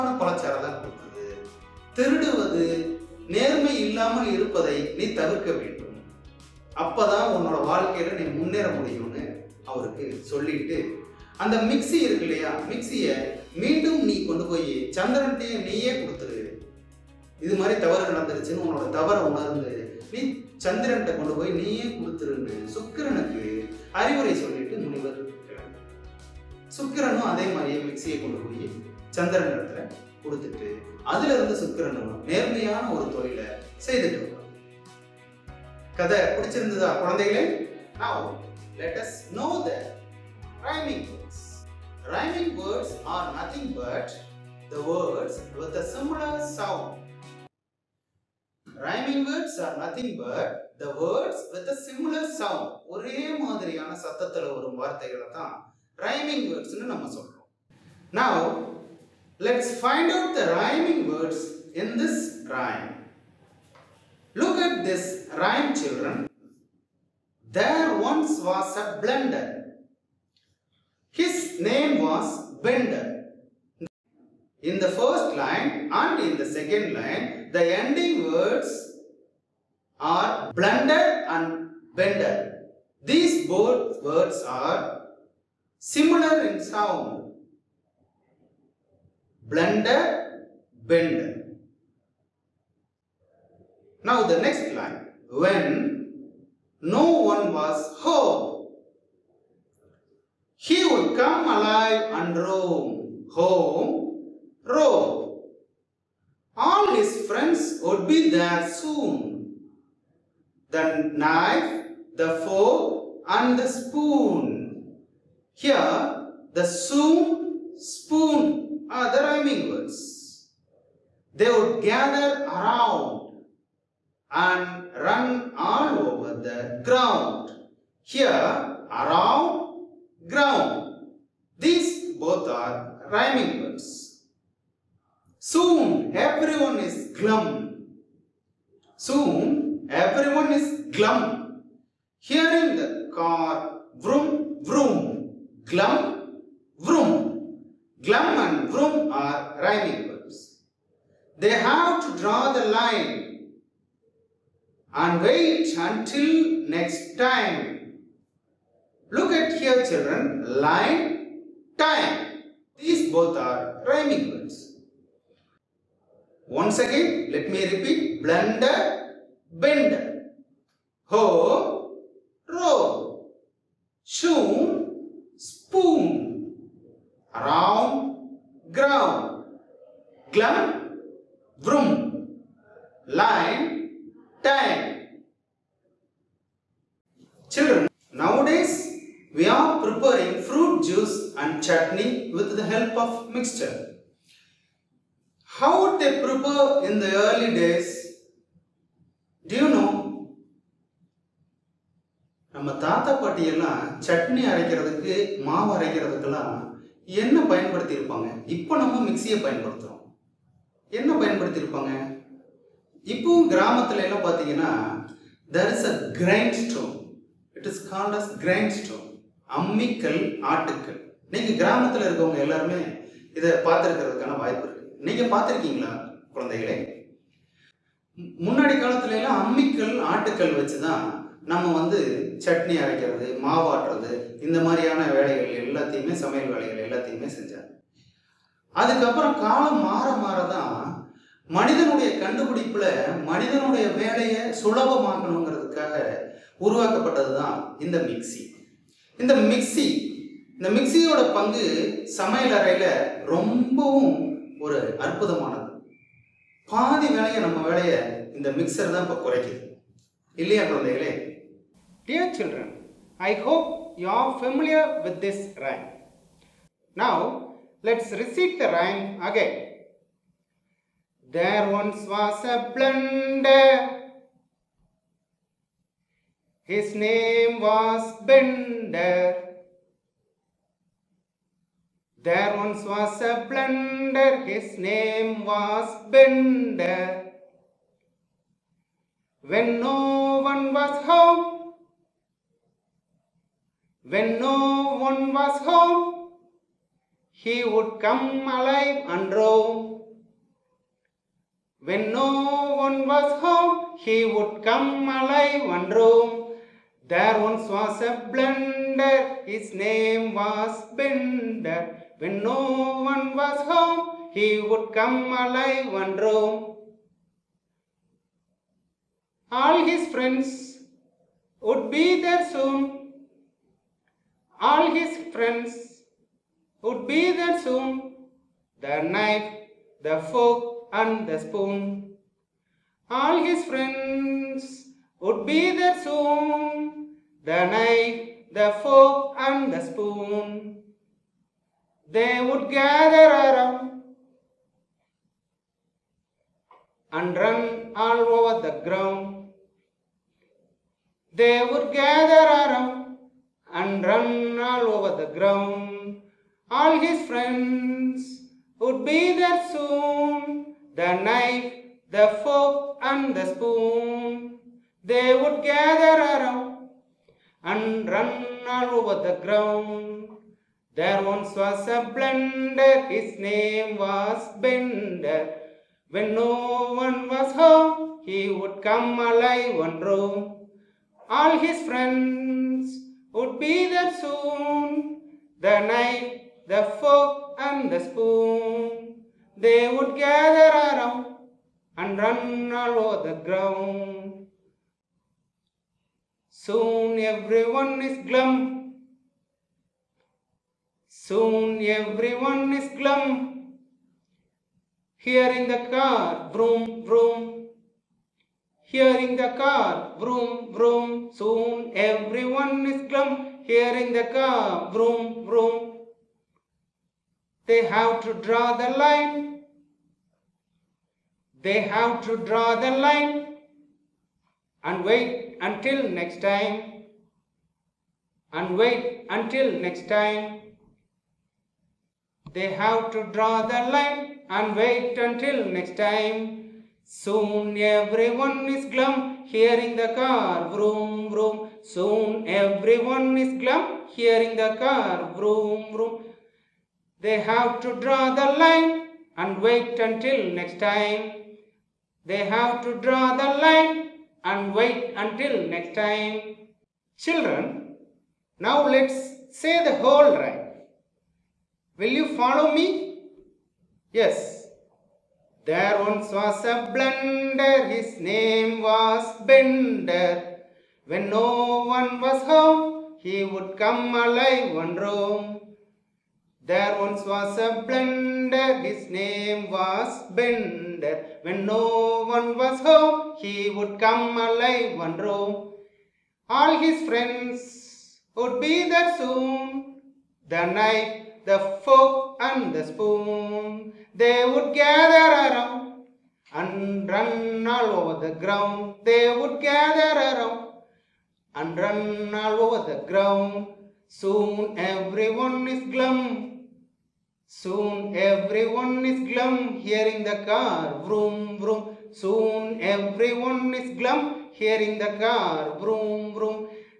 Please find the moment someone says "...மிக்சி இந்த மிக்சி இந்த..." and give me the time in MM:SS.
04:08.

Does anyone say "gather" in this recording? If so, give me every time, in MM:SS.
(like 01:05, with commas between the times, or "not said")
02:01, 05:42, 05:51, 06:05, 06:30, 08:14, 08:19.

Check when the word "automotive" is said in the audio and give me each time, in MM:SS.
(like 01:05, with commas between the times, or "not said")
not said.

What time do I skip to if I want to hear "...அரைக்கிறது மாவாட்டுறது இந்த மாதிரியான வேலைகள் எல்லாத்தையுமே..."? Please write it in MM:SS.
03:52.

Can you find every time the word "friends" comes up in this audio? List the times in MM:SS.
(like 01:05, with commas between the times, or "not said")
01:47, 05:20, 05:25, 05:33, 05:57, 06:21, 08:07.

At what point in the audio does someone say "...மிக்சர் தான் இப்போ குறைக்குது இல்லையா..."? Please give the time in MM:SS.
04:18.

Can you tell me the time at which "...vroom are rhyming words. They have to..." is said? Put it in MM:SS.
02:28.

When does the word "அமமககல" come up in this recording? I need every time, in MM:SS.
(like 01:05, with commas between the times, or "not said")
03:39, 03:49.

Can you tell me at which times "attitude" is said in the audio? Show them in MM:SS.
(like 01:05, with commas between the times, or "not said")
not said.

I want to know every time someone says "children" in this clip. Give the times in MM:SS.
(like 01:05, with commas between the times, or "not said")
01:05, 02:39, 07:37.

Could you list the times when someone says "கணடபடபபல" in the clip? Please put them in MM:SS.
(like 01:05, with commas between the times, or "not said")
04:02.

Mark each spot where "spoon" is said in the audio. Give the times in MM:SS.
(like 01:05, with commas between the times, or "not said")
01:53, 01:57, 05:31, 05:39, 06:03, 06:27, 08:12.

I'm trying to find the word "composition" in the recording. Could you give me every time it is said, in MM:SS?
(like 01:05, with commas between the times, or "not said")
not said.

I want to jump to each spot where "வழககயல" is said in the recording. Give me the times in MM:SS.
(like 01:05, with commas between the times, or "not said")
00:07.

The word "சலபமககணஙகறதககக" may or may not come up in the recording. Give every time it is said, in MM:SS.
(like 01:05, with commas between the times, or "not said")
04:04.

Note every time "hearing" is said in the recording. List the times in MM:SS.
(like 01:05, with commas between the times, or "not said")
02:22, 07:19, 07:24, 08:29, 08:34.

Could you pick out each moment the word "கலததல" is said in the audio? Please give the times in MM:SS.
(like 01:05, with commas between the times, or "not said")
03:48.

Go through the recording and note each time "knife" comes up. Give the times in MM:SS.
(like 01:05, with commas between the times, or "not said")
01:51, 05:29, 05:37, 06:01, 06:25.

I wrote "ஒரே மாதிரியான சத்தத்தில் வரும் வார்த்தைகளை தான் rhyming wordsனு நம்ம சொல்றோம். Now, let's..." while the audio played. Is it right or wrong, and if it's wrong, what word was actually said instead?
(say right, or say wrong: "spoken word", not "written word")
right.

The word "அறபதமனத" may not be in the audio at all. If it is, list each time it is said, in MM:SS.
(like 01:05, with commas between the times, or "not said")
04:15.